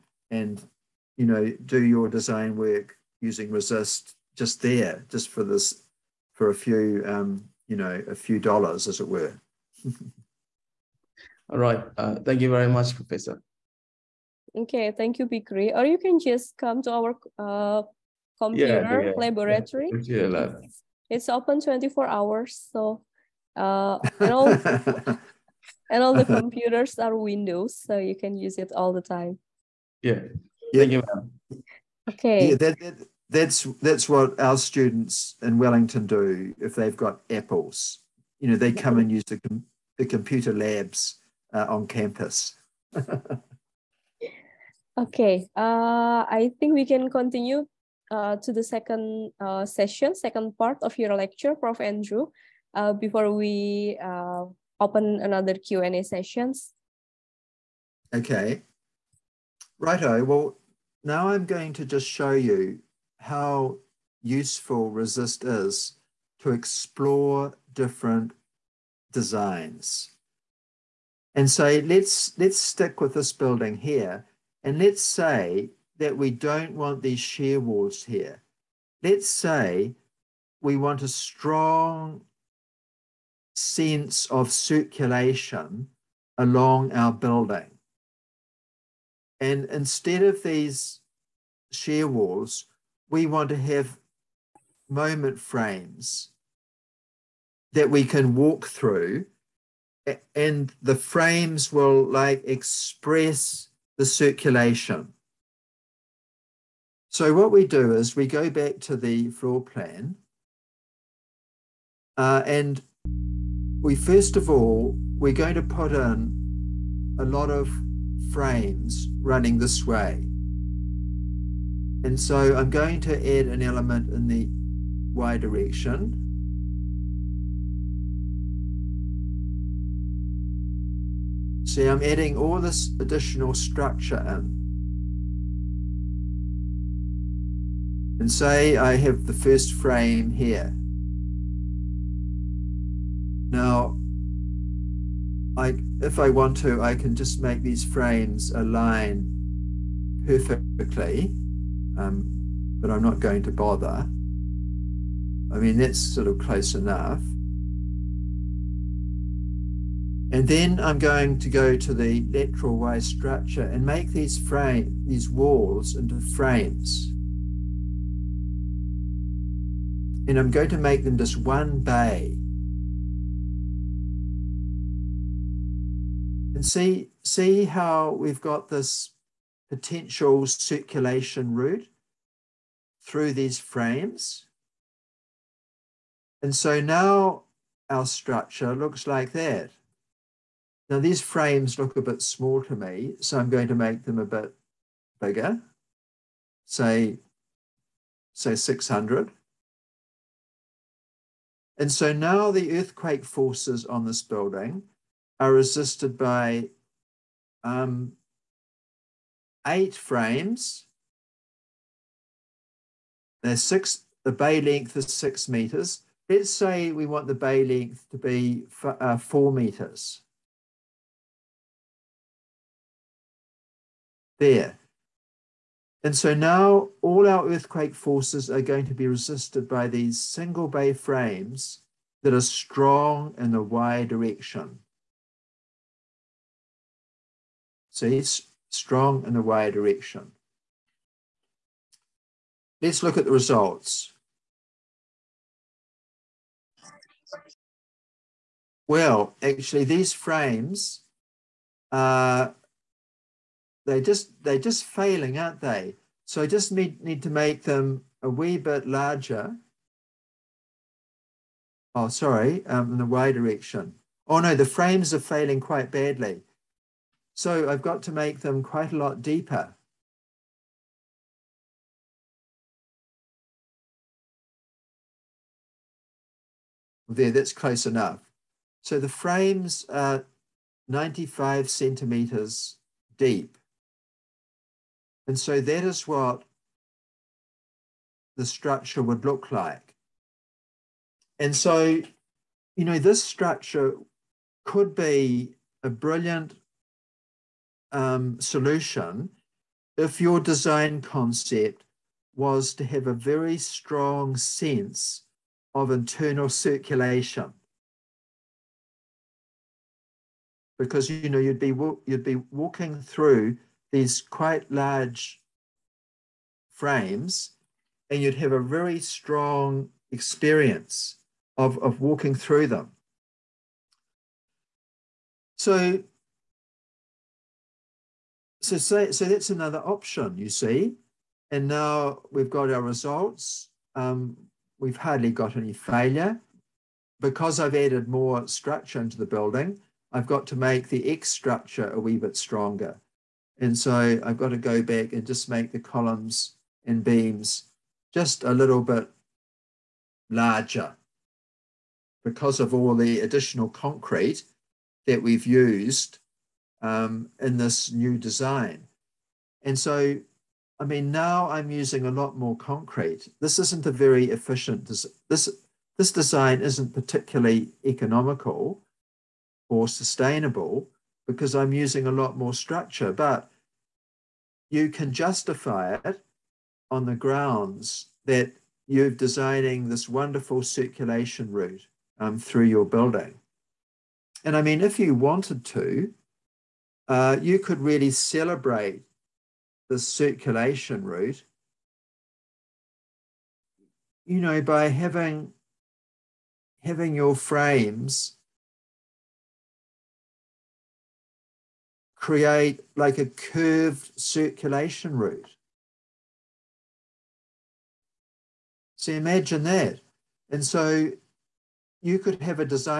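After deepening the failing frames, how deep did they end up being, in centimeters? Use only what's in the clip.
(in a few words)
95 centimeters.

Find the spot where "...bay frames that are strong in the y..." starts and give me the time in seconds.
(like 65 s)
230 s.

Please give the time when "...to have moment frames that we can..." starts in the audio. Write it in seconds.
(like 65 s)
93 s.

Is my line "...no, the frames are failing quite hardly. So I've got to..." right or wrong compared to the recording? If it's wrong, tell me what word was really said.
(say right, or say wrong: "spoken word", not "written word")
wrong: "badly", not "hardly".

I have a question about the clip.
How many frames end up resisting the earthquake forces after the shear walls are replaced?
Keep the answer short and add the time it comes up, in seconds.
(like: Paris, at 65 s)
8, at 209 s.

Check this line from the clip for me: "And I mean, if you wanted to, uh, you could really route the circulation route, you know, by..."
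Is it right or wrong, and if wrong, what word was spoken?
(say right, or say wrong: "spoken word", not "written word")
wrong: "celebrate", not "route".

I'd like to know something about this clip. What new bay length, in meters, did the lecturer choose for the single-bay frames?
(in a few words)
4 meters.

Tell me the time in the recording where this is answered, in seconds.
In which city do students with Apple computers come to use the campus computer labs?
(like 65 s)
35 s.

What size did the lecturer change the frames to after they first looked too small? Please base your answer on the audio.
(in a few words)
600.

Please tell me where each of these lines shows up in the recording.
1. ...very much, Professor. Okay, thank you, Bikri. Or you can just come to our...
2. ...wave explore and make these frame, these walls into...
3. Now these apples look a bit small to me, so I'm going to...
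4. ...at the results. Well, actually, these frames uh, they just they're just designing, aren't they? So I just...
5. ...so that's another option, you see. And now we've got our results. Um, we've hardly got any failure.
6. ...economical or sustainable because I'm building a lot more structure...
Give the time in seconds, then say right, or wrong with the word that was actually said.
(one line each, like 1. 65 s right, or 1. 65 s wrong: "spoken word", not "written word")
1. 12 s right
2. 162 s wrong: "structure", not "explore"
3. 190 s wrong: "frames", not "apples"
4. 243 s wrong: "failing", not "designing"
5. 329 s right
6. 367 s wrong: "using", not "building".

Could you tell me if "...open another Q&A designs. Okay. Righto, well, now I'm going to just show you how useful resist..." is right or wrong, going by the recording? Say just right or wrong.
wrong.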